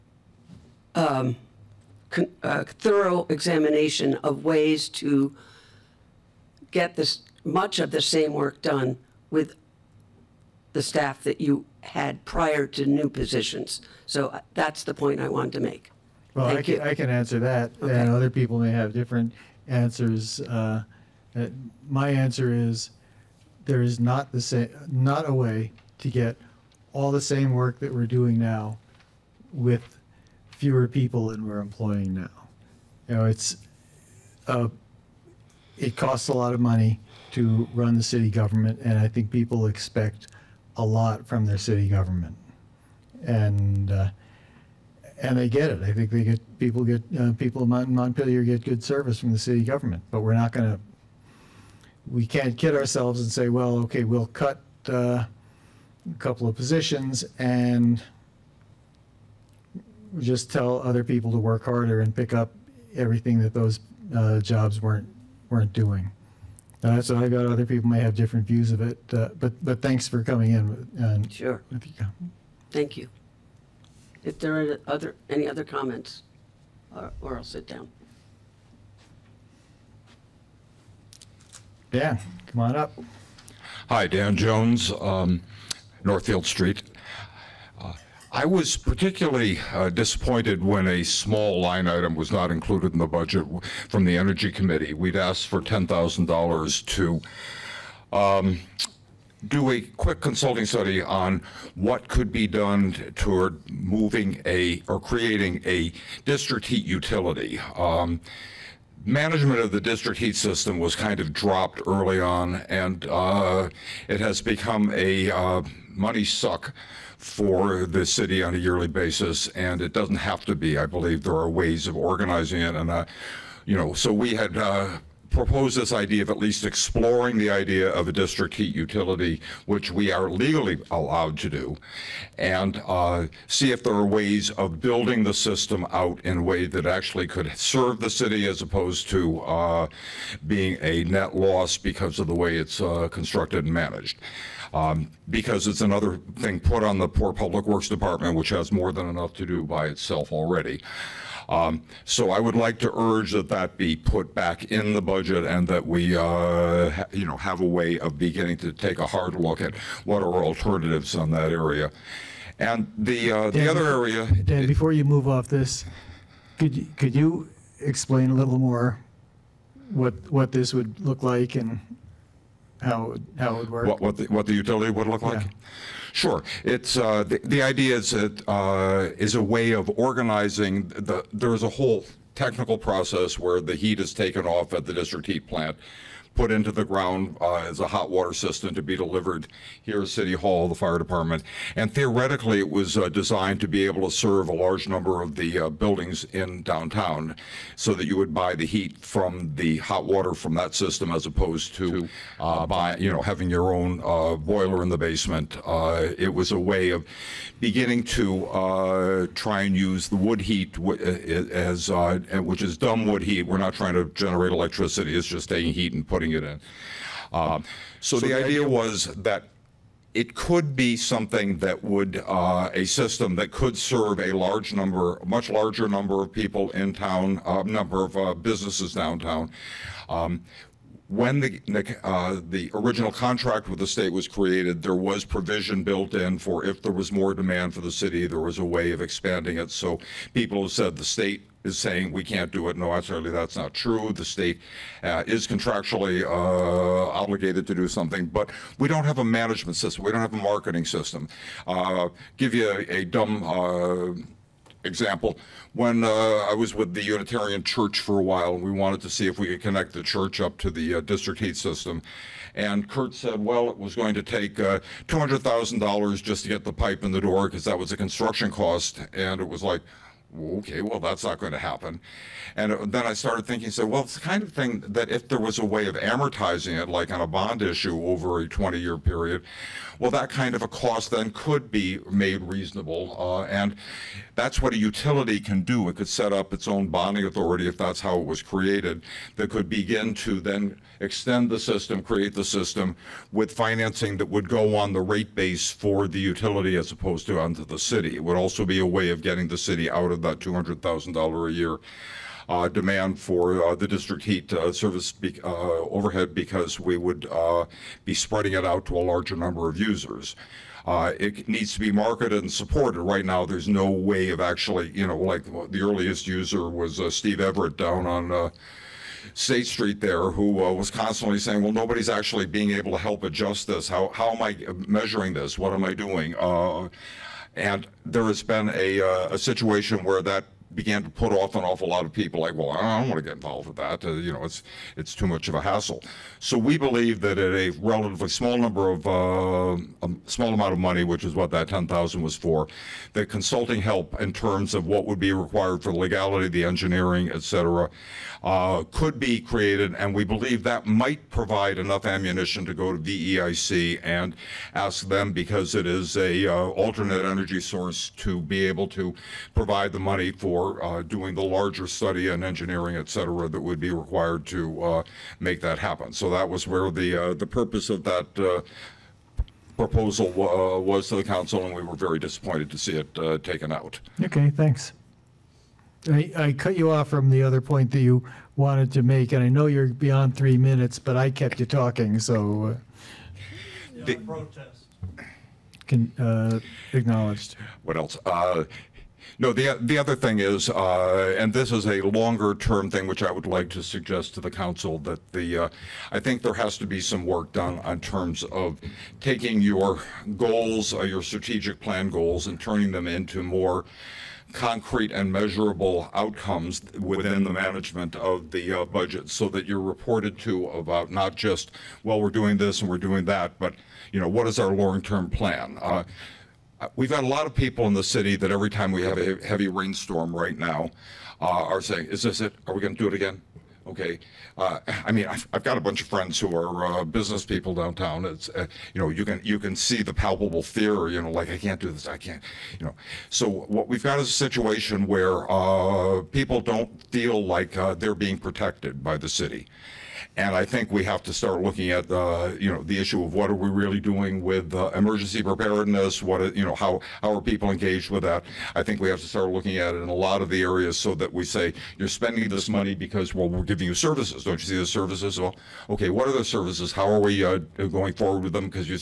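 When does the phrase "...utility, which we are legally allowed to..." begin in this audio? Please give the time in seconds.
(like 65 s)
128 s.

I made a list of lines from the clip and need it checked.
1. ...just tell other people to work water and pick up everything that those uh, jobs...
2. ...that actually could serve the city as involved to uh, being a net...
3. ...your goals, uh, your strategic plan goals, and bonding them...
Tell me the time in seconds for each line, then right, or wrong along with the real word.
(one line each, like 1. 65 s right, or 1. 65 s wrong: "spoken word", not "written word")
1. 60 s wrong: "harder", not "water"
2. 136 s wrong: "opposed", not "involved"
3. 399 s wrong: "turning", not "bonding".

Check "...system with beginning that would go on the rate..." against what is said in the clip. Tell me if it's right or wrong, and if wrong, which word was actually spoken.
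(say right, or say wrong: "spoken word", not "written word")
wrong: "financing", not "beginning".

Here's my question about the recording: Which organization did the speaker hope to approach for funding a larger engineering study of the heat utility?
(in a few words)
VEIC.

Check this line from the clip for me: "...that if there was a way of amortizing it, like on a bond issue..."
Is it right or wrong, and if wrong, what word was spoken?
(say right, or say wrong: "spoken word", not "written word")
right.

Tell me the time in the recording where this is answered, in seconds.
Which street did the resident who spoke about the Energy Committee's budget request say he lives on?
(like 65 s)
86 s.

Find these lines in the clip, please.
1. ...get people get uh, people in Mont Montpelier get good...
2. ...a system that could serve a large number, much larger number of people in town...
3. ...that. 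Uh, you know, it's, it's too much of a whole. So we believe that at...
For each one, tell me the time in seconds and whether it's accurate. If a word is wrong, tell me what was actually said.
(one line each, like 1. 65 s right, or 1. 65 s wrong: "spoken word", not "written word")
1. 46 s right
2. 222 s right
3. 333 s wrong: "hassle", not "whole".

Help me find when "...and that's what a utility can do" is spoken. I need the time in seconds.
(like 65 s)
283 s.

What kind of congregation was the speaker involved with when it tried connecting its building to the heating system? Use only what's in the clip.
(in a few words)
Unitarian Church.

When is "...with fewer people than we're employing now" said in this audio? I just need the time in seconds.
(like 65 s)
29 s.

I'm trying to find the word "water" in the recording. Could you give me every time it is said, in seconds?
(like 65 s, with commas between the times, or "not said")
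188 s, 200 s.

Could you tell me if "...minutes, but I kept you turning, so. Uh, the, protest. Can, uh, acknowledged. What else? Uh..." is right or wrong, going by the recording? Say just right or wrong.
wrong.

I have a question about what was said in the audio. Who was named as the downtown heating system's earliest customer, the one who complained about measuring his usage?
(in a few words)
Steve Everett.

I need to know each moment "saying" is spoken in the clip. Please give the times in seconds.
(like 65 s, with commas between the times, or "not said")
241 s, 321 s, 421 s.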